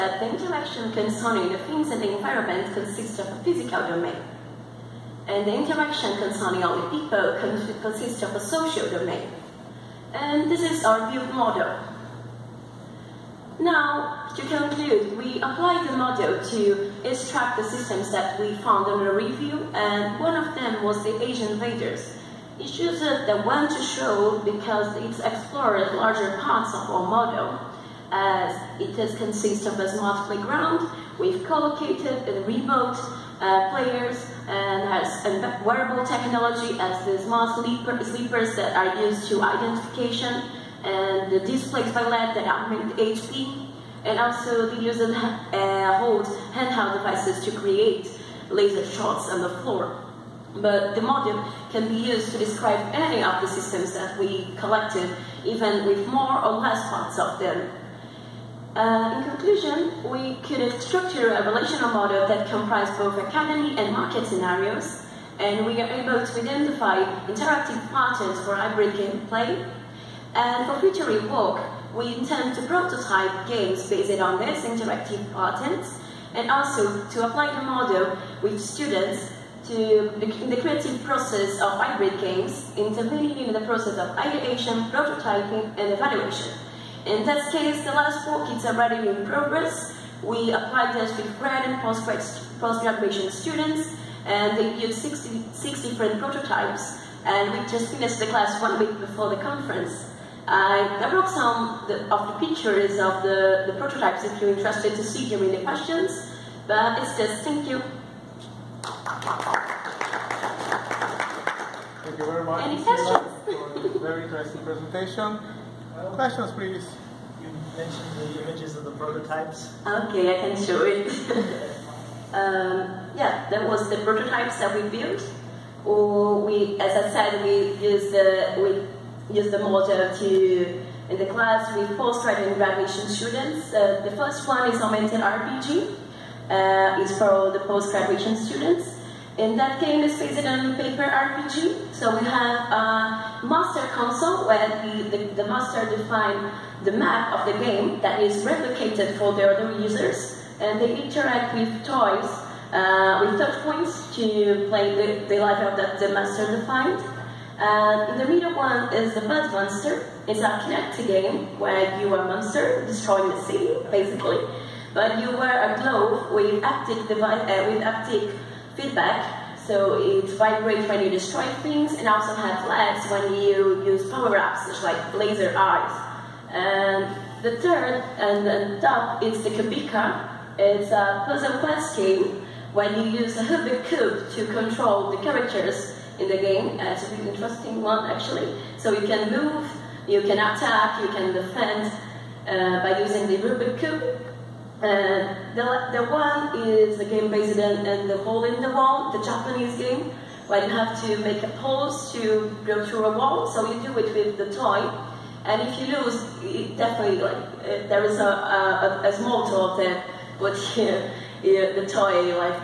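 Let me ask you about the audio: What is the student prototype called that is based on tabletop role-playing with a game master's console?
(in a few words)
Augmented RPG.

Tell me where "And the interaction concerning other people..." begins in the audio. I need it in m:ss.
0:05.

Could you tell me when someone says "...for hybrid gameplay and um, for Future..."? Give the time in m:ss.
1:08.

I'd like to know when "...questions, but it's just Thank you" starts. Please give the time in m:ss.
1:45.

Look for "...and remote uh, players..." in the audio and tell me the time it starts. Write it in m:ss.
0:32.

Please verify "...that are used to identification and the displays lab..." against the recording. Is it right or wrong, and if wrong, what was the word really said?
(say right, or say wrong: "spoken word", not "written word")
right.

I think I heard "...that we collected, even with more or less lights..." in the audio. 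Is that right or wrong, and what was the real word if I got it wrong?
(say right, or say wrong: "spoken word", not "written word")
wrong: "parts", not "lights".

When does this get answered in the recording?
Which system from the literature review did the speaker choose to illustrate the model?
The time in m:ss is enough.
0:21.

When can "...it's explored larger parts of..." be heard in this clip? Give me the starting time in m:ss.
0:24.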